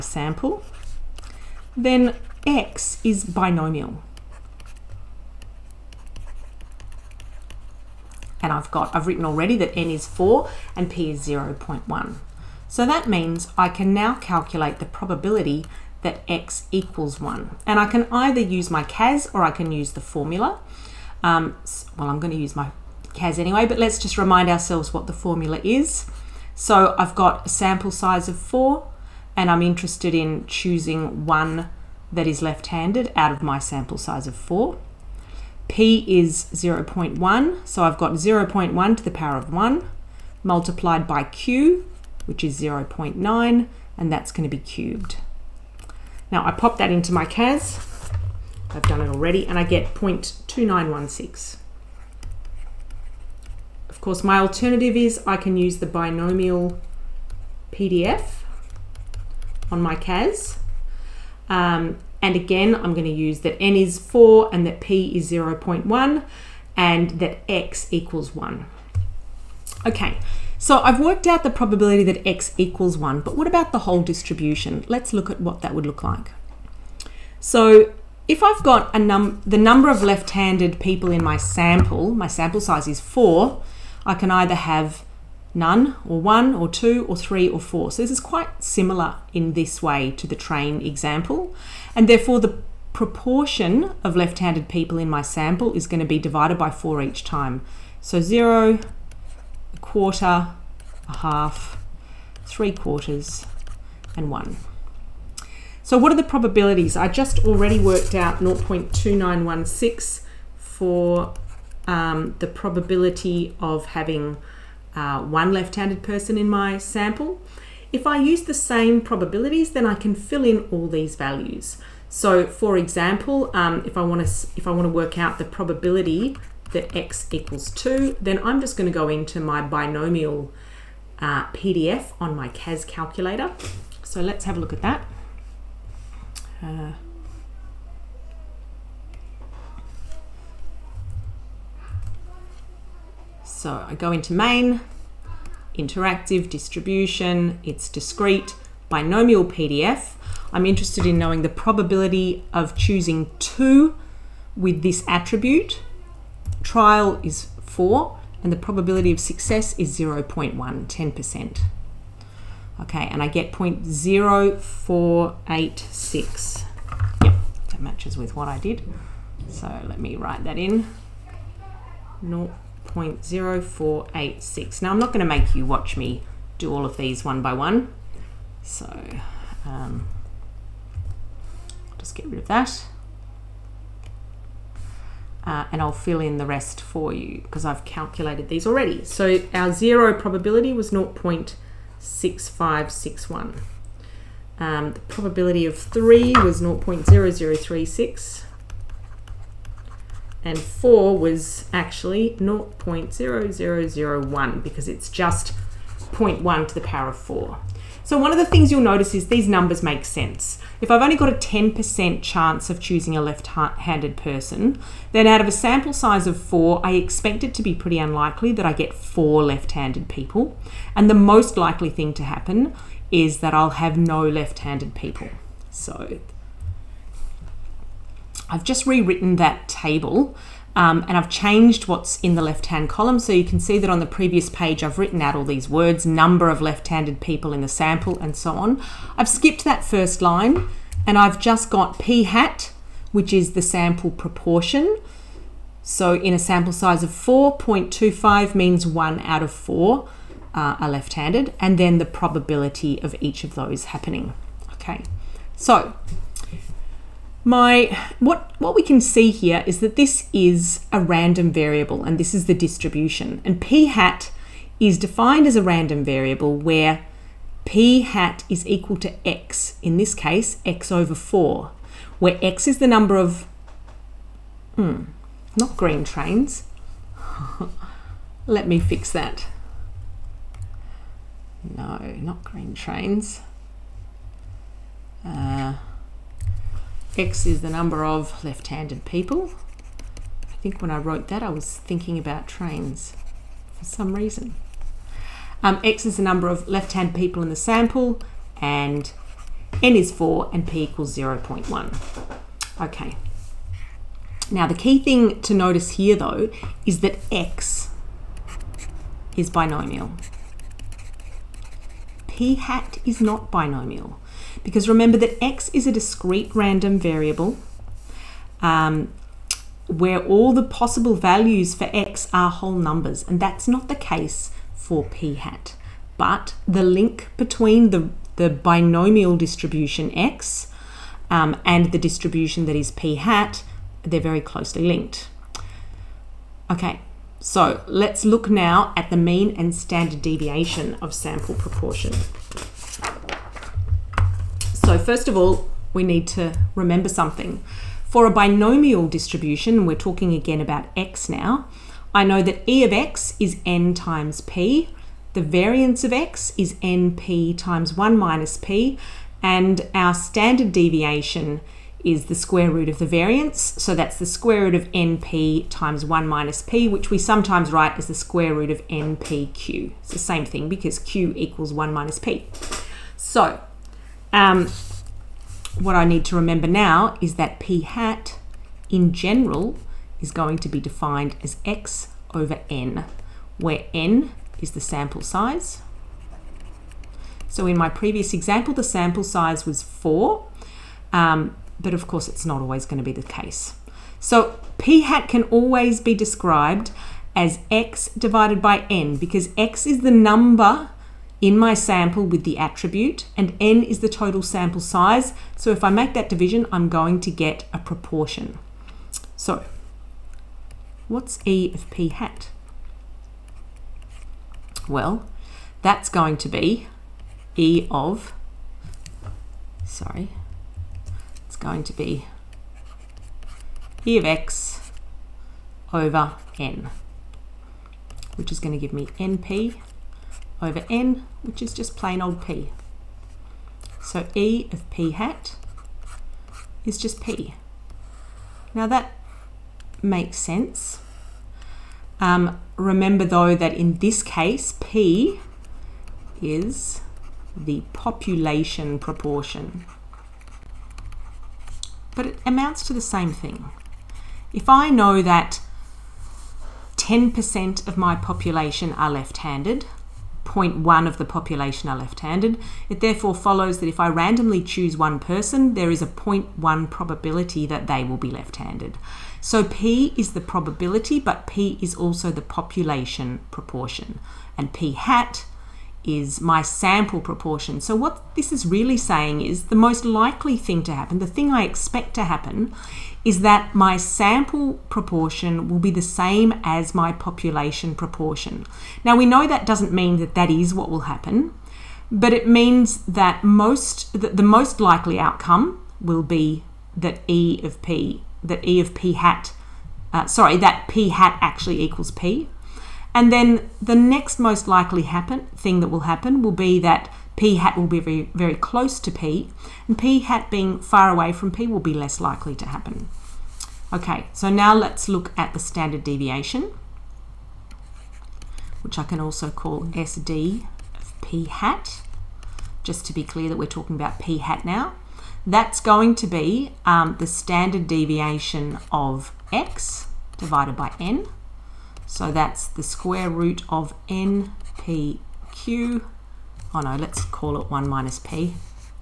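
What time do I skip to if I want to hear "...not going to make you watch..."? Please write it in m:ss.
2:54.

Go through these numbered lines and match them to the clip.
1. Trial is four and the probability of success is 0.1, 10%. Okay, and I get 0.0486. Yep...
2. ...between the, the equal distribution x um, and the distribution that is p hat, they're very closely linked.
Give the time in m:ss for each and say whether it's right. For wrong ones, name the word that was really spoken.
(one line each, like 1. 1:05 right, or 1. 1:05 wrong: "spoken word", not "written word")
1. 2:36 right
2. 5:27 wrong: "binomial", not "equal".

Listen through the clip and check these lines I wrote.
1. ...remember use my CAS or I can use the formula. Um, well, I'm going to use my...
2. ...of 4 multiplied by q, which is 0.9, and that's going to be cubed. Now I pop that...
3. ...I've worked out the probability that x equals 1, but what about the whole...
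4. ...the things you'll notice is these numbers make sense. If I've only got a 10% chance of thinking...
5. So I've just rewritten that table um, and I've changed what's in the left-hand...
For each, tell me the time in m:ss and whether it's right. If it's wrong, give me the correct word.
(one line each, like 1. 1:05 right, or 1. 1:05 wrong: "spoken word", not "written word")
1. 0:18 wrong: "either", not "remember"
2. 0:39 wrong: "1", not "4"
3. 1:10 right
4. 3:28 wrong: "choosing", not "thinking"
5. 3:45 right.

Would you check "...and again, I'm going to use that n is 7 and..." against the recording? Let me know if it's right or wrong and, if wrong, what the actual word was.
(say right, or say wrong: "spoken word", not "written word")
wrong: "4", not "7".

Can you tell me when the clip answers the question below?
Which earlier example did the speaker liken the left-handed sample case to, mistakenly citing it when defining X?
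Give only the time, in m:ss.
1:30.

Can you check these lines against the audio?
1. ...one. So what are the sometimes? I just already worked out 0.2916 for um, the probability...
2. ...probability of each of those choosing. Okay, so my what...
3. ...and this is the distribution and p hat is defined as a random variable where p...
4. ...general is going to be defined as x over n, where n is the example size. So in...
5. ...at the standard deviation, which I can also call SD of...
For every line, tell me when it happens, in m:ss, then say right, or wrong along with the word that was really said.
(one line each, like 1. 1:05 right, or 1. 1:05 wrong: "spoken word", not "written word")
1. 1:44 wrong: "probabilities", not "sometimes"
2. 4:12 wrong: "happening", not "choosing"
3. 4:22 right
4. 6:19 wrong: "sample", not "example"
5. 8:35 right.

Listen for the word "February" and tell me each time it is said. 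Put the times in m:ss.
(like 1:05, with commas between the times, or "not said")
not said.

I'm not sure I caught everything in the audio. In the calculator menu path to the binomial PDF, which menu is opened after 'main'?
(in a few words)
interactive.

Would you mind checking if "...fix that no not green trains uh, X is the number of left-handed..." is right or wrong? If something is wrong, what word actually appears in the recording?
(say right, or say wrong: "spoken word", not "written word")
right.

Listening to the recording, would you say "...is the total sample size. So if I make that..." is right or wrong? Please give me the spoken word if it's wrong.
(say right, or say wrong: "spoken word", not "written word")
right.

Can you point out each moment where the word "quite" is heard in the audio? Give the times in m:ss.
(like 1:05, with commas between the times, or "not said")
1:28.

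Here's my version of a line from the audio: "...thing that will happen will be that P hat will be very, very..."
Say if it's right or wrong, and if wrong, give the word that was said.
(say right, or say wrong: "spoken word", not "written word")
right.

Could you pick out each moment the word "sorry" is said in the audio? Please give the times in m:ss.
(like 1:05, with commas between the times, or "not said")
6:59, 8:20.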